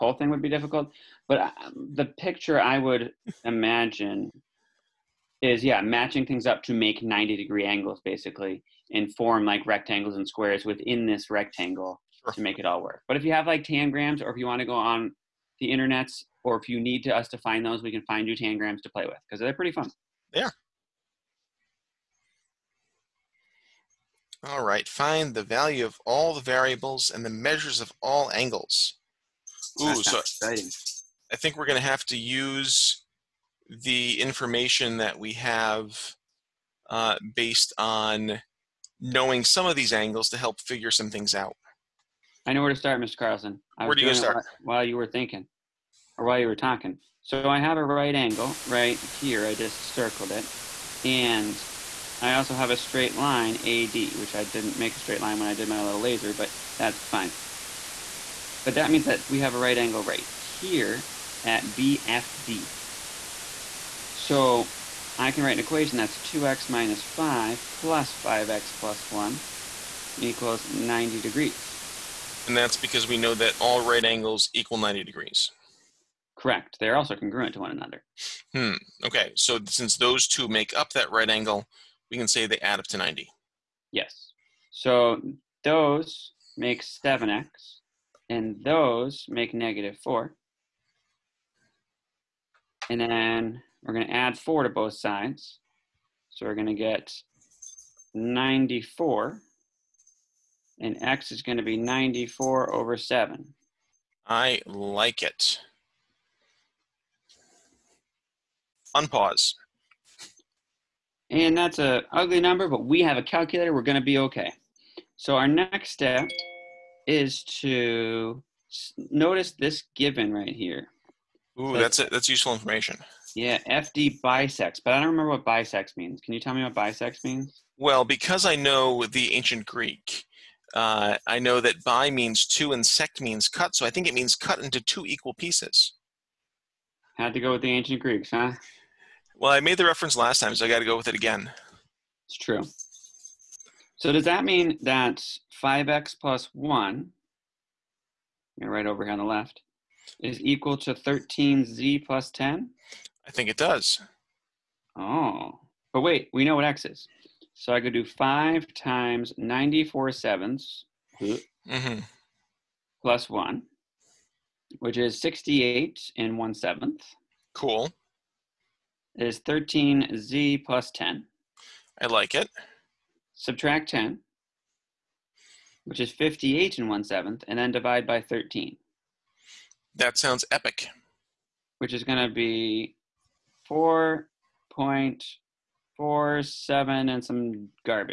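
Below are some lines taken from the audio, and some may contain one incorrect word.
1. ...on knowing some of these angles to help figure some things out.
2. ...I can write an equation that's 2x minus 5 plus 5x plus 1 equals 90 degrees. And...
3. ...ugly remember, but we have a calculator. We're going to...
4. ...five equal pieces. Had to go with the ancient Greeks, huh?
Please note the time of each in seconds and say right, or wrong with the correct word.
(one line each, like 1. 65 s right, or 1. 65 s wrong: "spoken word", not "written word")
1. 37 s right
2. 65 s right
3. 112 s wrong: "number", not "remember"
4. 134 s wrong: "two", not "five".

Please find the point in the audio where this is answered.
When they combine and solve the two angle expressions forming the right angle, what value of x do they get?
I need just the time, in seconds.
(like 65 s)
101 s.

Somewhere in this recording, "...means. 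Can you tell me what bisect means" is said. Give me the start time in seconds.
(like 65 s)
125 s.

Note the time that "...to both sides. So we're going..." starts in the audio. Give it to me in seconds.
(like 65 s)
94 s.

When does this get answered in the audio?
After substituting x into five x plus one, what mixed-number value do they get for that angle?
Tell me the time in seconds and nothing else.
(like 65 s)
165 s.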